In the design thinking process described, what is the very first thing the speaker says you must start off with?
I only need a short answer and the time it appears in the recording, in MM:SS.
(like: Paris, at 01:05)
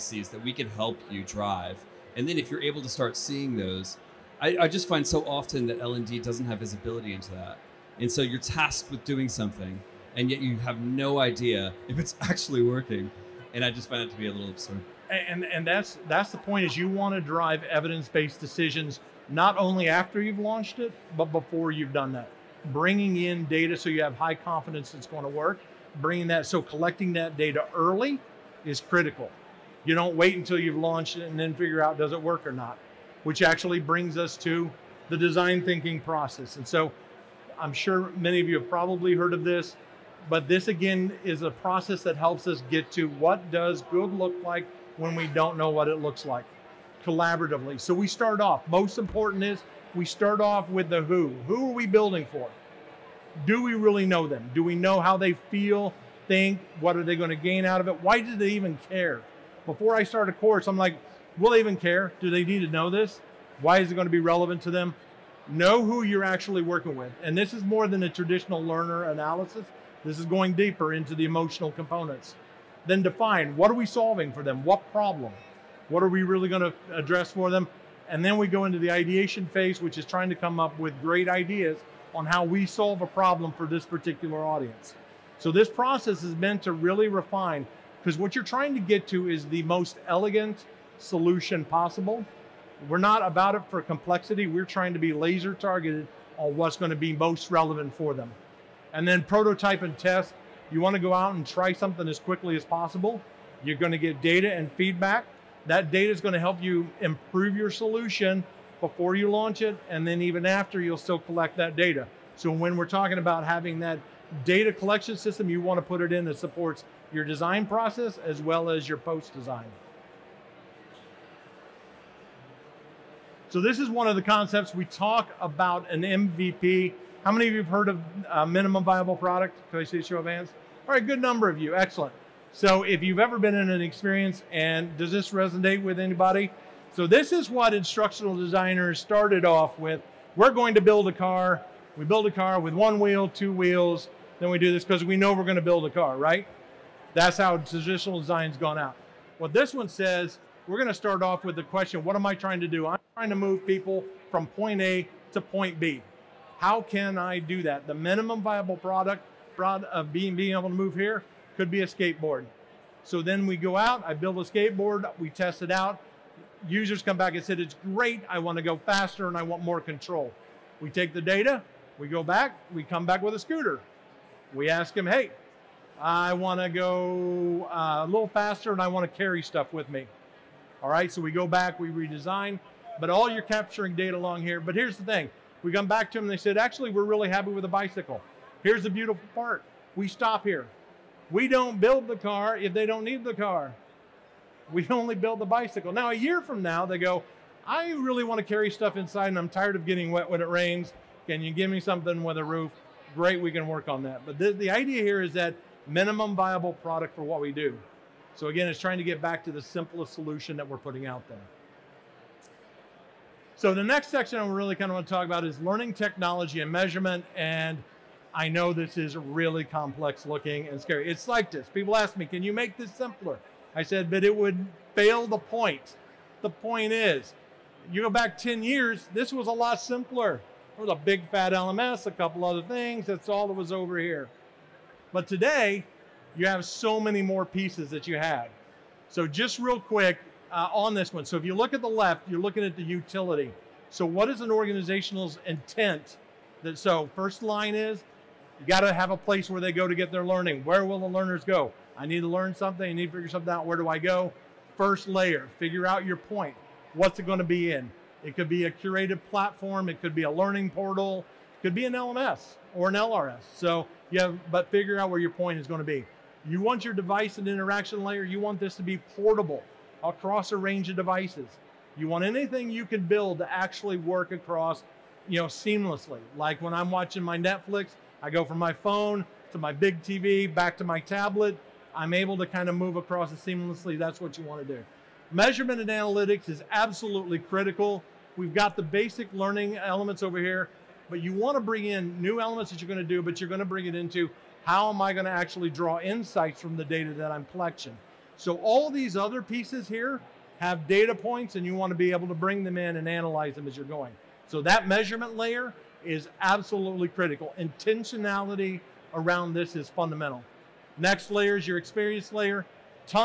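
The who, at 00:50.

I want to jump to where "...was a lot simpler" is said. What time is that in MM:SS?
03:49.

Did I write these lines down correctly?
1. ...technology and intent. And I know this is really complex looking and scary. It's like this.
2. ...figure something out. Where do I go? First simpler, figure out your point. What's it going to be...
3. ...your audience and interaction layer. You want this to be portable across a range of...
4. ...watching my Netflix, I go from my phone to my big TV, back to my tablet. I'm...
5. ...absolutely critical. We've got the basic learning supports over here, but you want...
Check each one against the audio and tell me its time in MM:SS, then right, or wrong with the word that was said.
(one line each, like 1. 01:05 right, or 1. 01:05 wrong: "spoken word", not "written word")
1. 03:35 wrong: "measurement", not "intent"
2. 04:13 wrong: "layer", not "simpler"
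3. 04:26 wrong: "device", not "audience"
4. 04:36 right
5. 04:46 wrong: "elements", not "supports".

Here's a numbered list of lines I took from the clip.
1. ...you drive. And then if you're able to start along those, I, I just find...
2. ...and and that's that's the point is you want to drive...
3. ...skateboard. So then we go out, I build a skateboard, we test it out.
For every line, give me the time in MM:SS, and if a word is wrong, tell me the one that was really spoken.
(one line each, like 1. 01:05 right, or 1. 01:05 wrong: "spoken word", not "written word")
1. 00:01 wrong: "seeing", not "along"
2. 00:15 right
3. 02:41 right.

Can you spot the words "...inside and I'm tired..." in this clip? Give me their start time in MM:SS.
03:18.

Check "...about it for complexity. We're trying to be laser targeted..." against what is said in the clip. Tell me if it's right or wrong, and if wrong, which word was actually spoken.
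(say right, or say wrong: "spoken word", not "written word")
right.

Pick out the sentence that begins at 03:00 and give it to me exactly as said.
All right, so we go back, we redesign, but all you're capturing data along here.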